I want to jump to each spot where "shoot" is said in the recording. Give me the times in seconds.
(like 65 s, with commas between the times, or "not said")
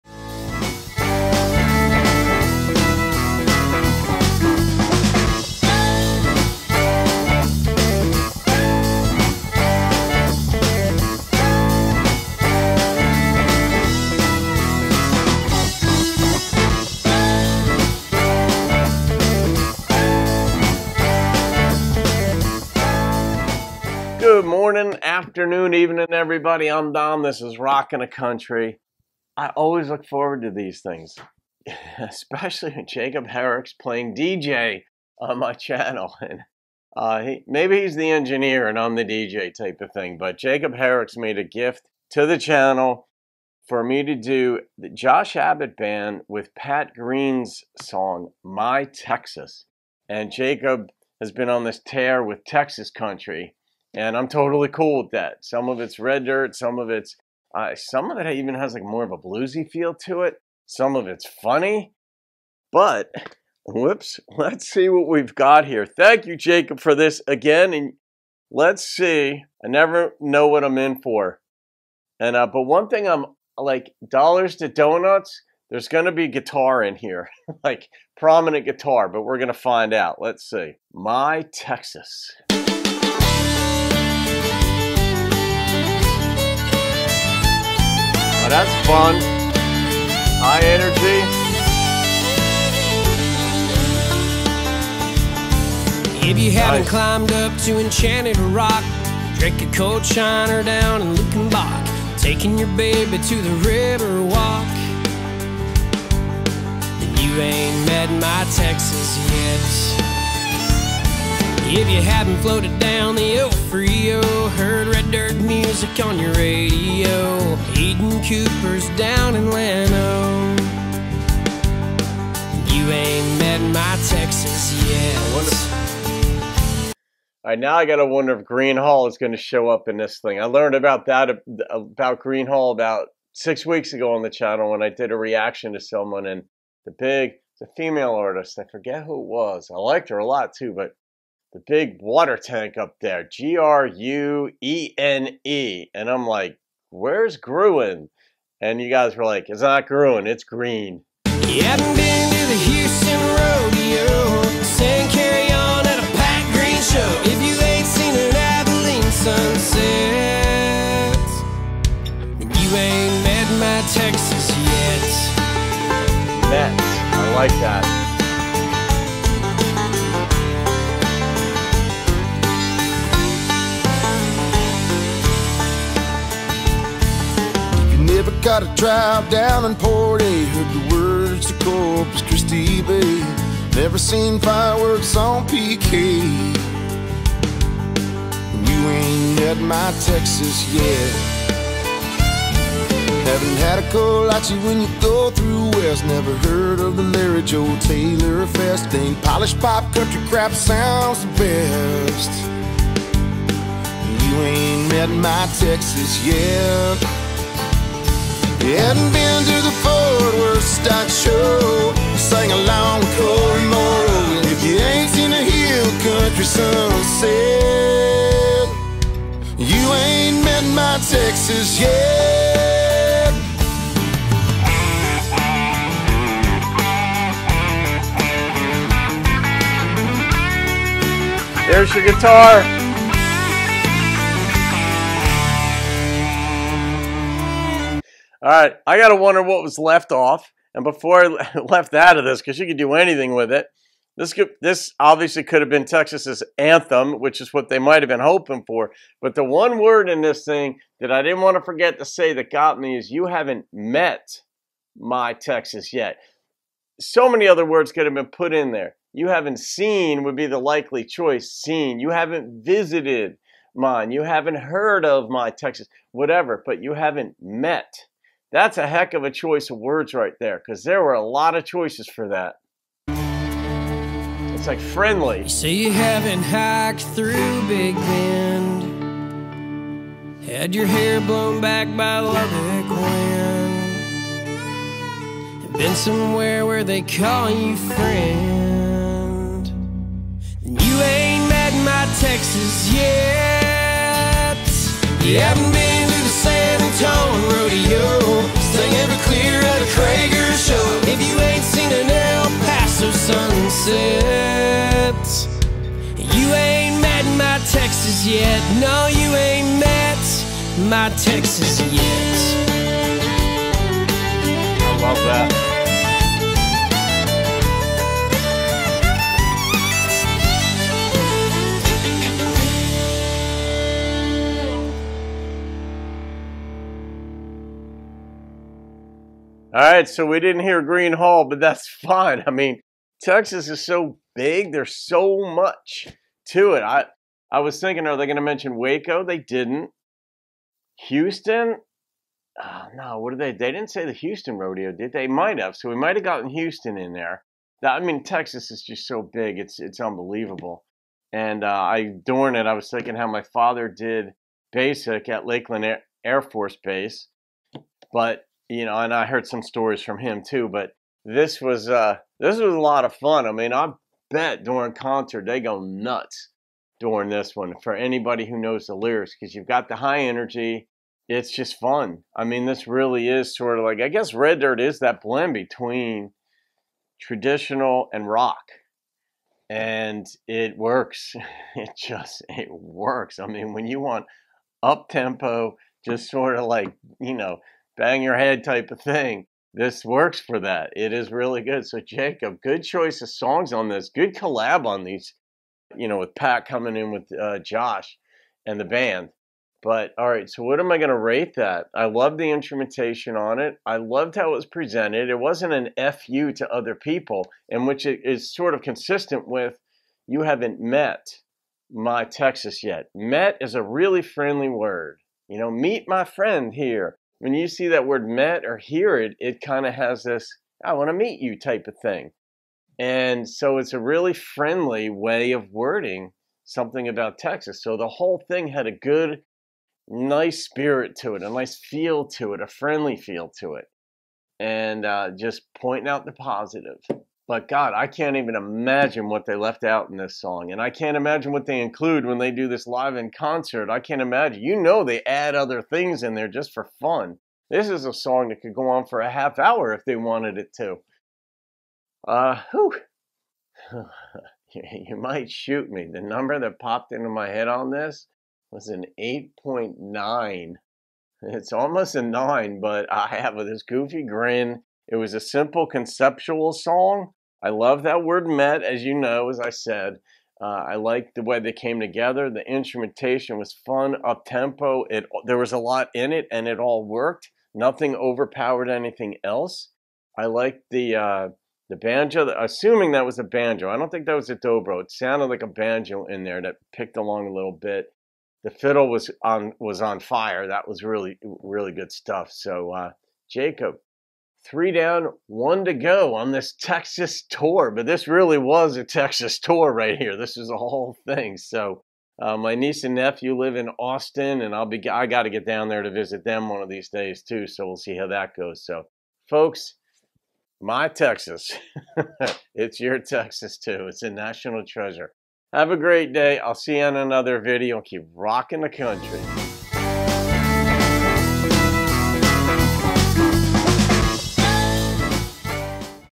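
455 s.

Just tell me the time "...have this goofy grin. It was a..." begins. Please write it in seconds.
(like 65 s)
463 s.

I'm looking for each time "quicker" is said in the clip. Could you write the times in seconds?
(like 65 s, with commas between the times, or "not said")
not said.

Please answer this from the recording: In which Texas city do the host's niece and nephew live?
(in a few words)
Austin.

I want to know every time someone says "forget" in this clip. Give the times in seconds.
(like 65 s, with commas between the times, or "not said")
138 s, 251 s.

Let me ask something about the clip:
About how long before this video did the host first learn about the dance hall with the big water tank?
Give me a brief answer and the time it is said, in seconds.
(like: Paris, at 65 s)
About 6 weeks, at 133 s.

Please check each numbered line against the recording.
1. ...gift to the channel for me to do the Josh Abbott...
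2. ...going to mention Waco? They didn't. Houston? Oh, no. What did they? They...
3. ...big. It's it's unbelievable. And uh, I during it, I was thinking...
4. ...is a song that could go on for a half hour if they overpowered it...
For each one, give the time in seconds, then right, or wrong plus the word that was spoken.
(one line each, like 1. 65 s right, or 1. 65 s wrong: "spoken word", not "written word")
1. 41 s right
2. 338 s right
3. 349 s right
4. 447 s wrong: "wanted", not "overpowered".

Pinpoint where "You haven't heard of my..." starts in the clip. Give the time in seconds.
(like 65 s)
264 s.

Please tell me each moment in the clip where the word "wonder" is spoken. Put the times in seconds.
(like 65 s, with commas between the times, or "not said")
128 s, 239 s.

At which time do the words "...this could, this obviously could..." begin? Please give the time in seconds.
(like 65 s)
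244 s.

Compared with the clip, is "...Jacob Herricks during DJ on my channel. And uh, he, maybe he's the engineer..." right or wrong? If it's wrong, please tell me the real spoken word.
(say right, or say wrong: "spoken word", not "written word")
wrong: "playing", not "during".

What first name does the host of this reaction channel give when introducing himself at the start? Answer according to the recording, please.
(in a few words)
Don.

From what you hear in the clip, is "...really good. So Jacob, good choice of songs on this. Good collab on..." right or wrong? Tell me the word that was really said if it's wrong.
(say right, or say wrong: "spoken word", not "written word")
right.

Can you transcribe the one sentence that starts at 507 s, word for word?
So we'll see how that goes.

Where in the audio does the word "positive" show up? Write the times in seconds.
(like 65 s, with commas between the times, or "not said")
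436 s.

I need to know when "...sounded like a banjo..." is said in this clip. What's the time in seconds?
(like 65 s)
485 s.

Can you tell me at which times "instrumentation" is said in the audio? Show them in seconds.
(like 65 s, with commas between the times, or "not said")
402 s, 472 s.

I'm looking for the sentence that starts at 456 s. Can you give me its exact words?
The number that popped into my head on this was an 8.9.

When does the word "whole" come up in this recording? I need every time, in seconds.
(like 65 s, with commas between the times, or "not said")
428 s, 500 s.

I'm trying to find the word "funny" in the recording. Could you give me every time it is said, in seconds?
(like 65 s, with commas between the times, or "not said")
61 s.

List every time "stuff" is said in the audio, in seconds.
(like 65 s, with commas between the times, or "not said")
492 s.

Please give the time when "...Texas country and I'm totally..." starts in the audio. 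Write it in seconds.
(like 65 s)
52 s.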